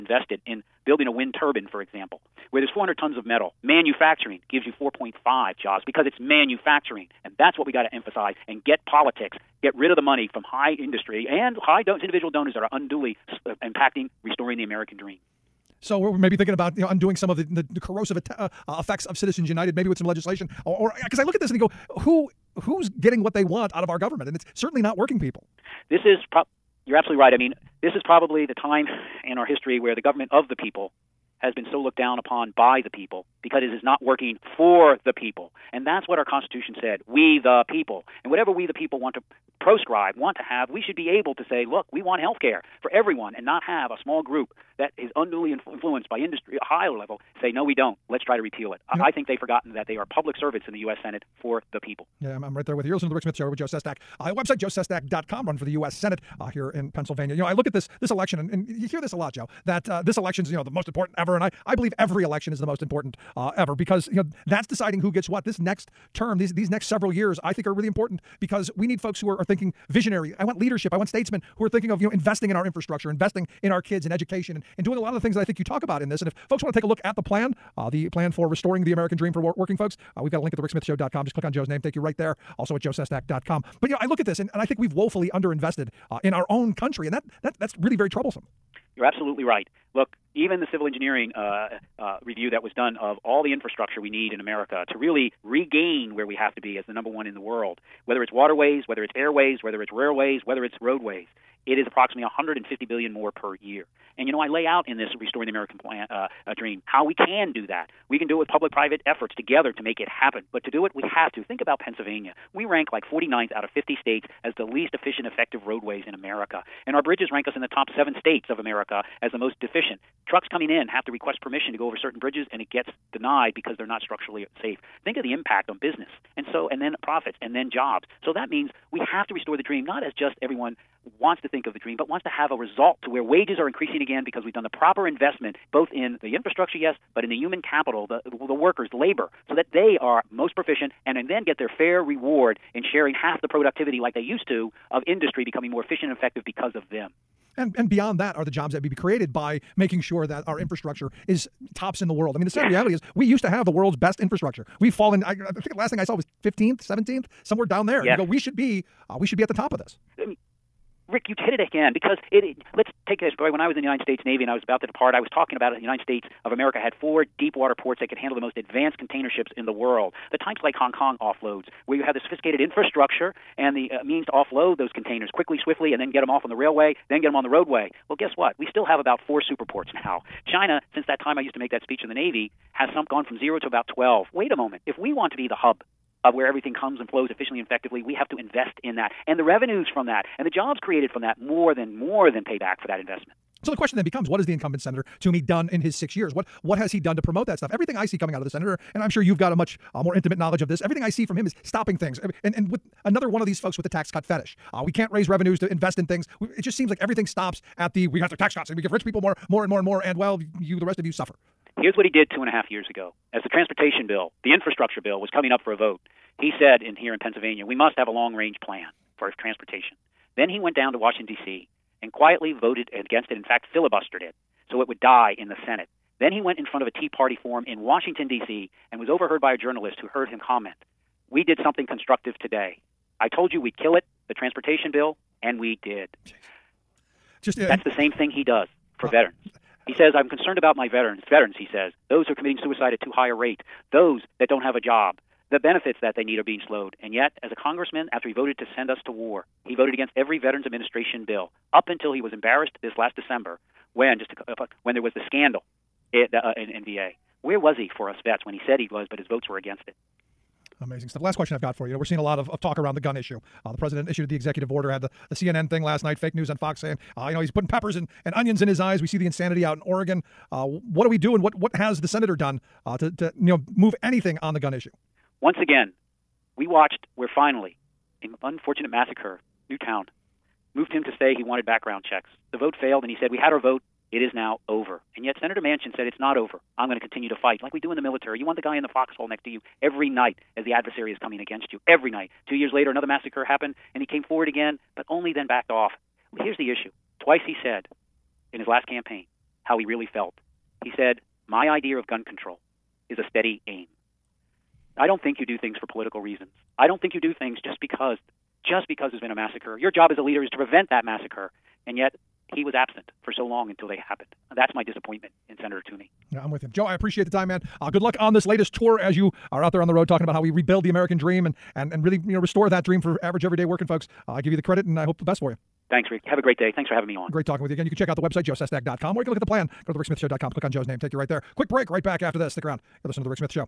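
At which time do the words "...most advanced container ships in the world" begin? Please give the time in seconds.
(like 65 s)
168 s.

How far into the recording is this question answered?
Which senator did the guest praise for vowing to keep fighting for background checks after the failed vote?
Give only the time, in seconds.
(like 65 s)
285 s.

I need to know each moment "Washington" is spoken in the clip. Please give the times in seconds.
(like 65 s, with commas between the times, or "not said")
220 s, 227 s.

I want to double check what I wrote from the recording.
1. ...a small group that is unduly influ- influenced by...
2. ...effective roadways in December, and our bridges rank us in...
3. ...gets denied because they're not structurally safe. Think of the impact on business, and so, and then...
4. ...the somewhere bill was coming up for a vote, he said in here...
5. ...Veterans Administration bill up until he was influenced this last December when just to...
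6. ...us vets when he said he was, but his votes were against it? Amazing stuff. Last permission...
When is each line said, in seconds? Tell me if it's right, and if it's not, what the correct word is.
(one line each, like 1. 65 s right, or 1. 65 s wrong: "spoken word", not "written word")
1. 43 s right
2. 115 s wrong: "America", not "December"
3. 122 s right
4. 214 s wrong: "infrastructure", not "somewhere"
5. 250 s wrong: "embarrassed", not "influenced"
6. 258 s wrong: "question", not "permission".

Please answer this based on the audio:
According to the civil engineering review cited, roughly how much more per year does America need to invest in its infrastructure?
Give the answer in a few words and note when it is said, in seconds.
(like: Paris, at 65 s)
150 billion, at 102 s.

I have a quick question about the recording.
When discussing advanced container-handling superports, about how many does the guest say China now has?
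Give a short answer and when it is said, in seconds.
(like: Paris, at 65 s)
12, at 183 s.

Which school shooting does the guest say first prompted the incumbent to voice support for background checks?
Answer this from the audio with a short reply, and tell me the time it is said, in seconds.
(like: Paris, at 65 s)
Newtown, at 279 s.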